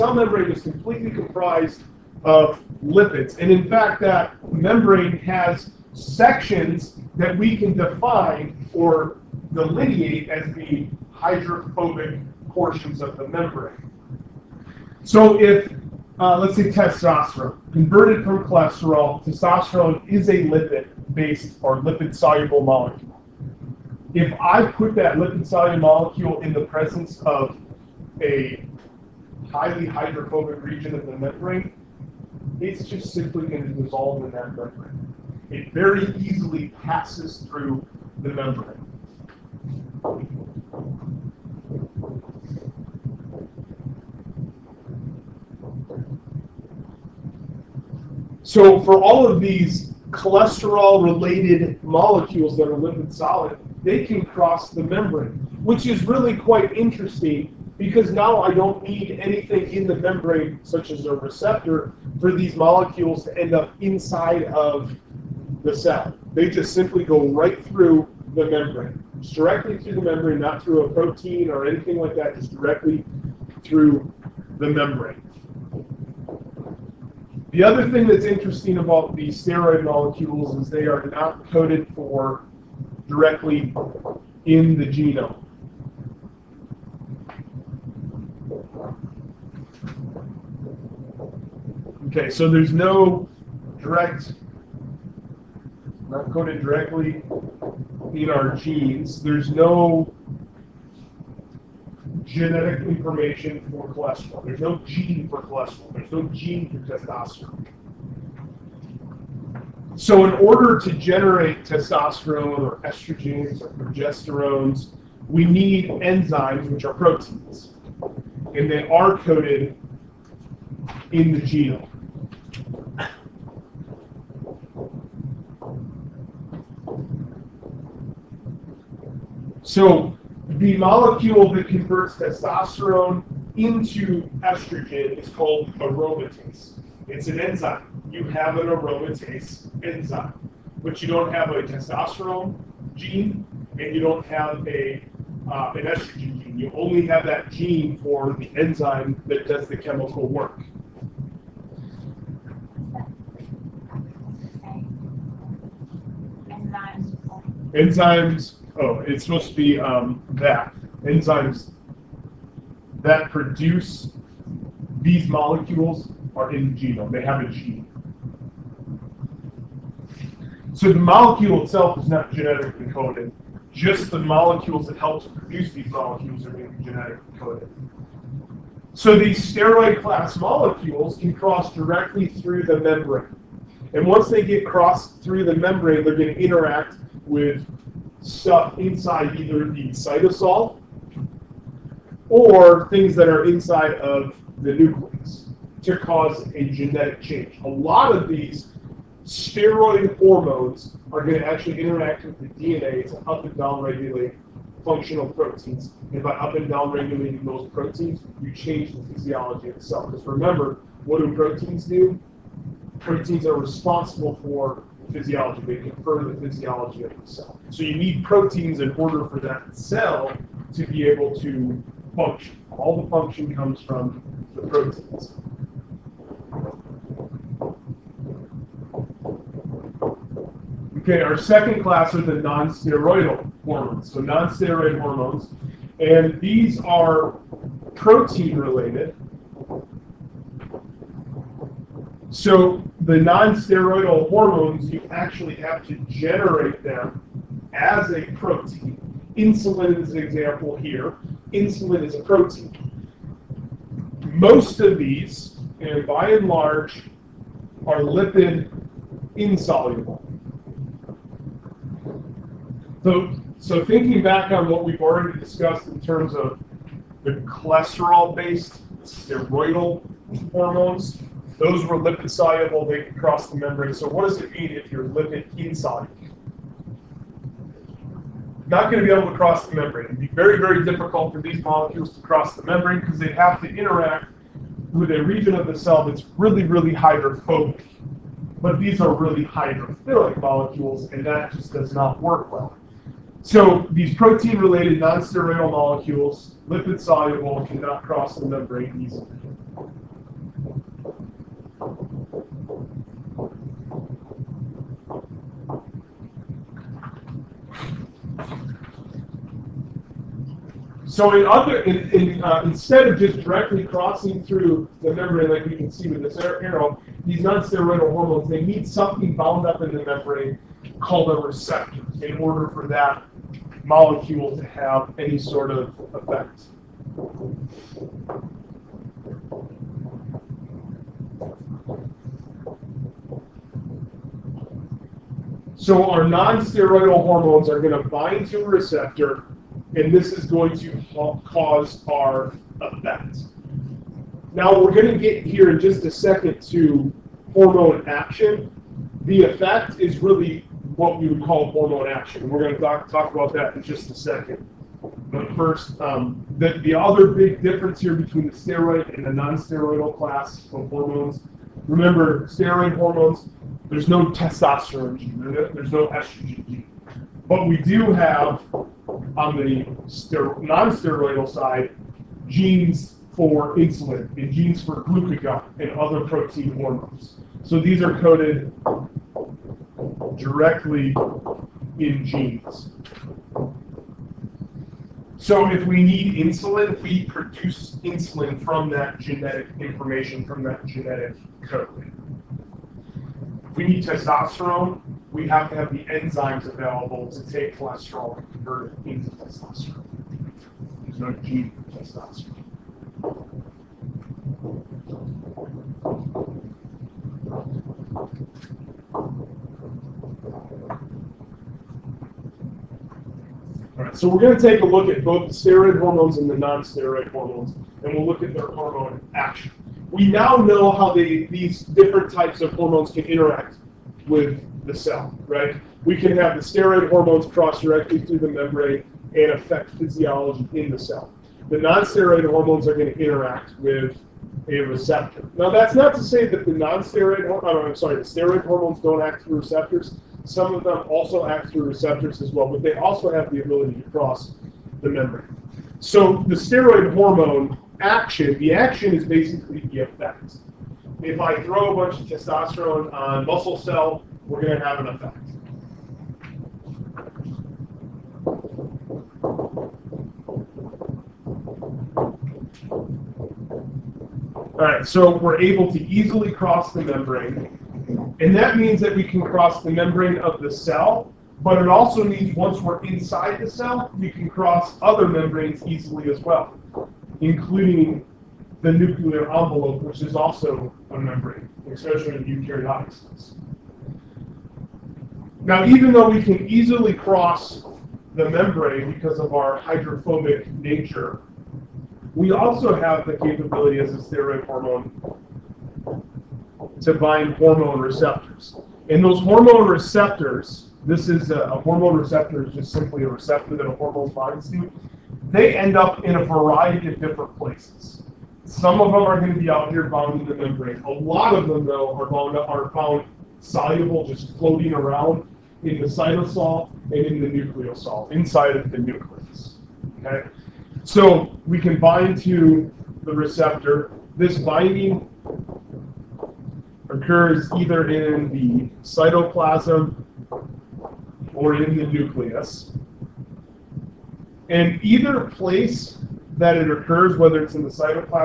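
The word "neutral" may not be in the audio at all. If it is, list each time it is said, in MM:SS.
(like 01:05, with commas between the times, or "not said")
not said.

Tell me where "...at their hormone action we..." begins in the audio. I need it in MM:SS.
06:58.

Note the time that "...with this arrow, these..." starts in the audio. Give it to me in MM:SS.
05:16.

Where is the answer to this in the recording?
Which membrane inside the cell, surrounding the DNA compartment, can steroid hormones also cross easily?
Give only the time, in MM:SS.
07:58.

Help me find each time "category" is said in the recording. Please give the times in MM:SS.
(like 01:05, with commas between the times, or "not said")
not said.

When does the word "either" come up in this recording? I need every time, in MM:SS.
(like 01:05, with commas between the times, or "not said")
03:09, 08:47, 08:55.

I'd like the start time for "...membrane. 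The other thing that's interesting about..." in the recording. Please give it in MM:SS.
01:14.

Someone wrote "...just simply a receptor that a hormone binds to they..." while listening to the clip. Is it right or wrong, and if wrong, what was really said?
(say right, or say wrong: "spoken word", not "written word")
right.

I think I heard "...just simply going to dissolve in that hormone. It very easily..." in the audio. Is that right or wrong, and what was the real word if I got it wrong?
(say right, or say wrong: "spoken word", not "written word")
wrong: "membrane", not "hormone".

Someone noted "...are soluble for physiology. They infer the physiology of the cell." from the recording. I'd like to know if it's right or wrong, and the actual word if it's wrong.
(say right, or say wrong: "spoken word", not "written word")
wrong: "responsible", not "soluble".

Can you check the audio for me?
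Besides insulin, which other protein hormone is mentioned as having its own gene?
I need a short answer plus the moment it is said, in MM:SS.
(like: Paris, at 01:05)
Glucagon, at 06:15.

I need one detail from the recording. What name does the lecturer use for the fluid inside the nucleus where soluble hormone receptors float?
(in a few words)
Nucleosol.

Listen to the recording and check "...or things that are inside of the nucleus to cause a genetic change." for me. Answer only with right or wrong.
right.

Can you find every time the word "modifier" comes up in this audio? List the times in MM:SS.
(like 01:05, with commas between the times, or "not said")
not said.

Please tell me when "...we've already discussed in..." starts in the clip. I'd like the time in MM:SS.
04:24.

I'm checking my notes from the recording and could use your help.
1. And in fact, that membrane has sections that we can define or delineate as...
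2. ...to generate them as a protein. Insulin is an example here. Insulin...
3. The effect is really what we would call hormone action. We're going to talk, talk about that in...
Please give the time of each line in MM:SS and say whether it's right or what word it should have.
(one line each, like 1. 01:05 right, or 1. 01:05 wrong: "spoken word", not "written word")
1. 00:03 right
2. 04:05 right
3. 05:49 right.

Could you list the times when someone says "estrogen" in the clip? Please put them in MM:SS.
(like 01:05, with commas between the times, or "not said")
01:52, 02:14, 02:25, 06:06.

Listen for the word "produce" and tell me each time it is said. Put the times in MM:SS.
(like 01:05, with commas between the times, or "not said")
02:43, 02:55, 06:27.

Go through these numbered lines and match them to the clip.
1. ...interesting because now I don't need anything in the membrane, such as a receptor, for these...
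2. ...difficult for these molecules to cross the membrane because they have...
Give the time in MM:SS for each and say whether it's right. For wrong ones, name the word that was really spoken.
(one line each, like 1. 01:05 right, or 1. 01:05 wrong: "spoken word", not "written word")
1. 00:56 right
2. 04:40 right.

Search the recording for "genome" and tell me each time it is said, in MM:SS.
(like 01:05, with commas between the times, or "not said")
01:24, 02:01, 02:46.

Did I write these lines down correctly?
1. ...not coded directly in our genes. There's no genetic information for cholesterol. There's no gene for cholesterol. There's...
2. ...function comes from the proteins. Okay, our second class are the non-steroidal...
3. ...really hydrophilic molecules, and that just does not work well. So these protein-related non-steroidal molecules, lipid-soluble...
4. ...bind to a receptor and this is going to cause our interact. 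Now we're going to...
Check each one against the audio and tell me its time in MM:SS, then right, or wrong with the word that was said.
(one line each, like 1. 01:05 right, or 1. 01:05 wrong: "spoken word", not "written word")
1. 01:36 right
2. 03:43 right
3. 04:49 right
4. 05:38 wrong: "effect", not "interact".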